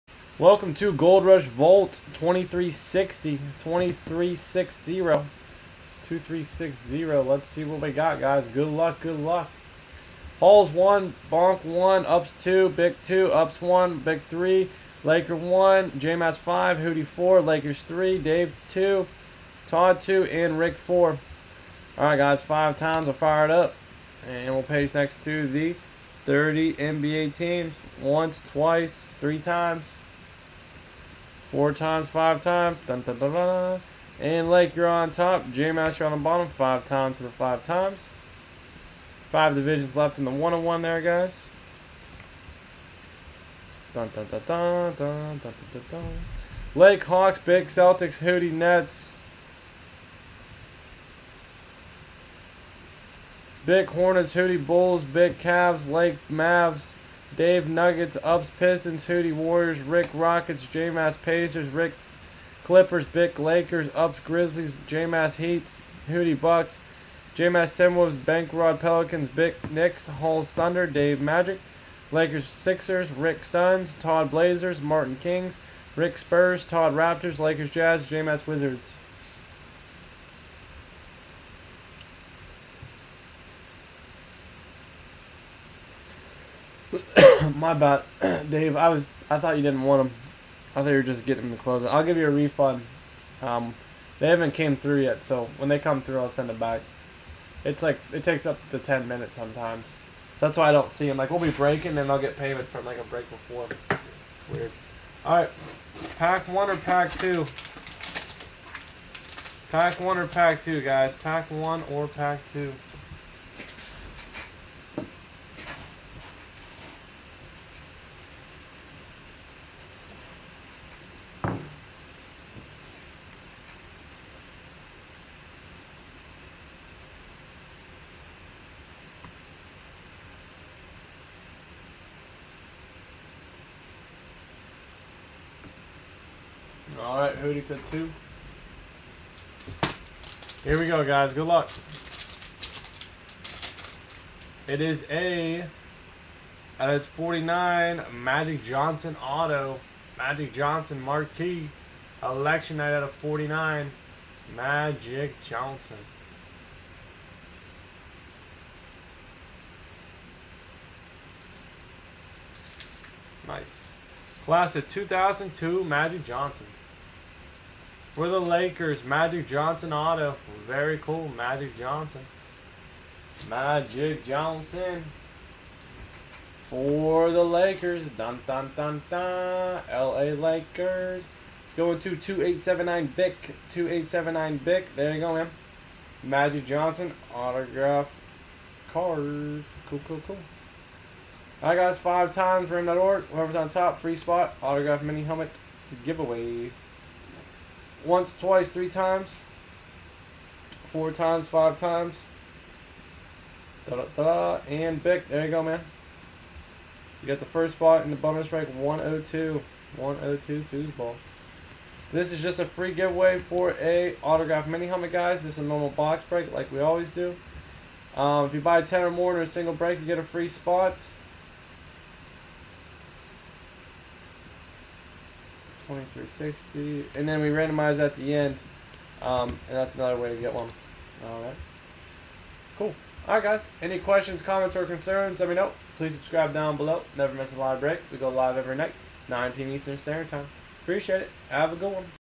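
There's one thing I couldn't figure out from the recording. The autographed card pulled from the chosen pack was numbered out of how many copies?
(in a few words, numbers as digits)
49.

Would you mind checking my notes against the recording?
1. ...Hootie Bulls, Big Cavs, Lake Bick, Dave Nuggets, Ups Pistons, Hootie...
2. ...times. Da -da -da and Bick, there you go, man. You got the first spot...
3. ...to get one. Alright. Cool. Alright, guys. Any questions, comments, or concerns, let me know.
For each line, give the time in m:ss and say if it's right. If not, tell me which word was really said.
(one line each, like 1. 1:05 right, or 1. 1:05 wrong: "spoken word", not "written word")
1. 0:54 wrong: "Mavs", not "Bick"
2. 3:21 right
3. 3:50 right.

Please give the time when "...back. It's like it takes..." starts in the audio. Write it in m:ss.
1:36.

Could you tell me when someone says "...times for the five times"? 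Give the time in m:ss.
0:36.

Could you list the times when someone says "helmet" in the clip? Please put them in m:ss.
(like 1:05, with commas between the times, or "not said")
3:15, 3:34.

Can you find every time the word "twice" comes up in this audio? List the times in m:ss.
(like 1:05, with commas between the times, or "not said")
0:28, 3:18.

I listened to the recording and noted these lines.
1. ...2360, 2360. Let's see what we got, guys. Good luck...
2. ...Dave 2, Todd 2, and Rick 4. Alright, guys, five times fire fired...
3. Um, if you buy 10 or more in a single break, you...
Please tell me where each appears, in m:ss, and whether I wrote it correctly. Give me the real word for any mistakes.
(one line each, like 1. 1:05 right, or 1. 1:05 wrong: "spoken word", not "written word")
1. 0:03 right
2. 0:18 right
3. 3:38 right.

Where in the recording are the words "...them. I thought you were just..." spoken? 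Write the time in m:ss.
1:30.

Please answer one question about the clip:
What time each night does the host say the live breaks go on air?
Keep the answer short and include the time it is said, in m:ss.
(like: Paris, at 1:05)
9 p.m. Eastern, at 3:59.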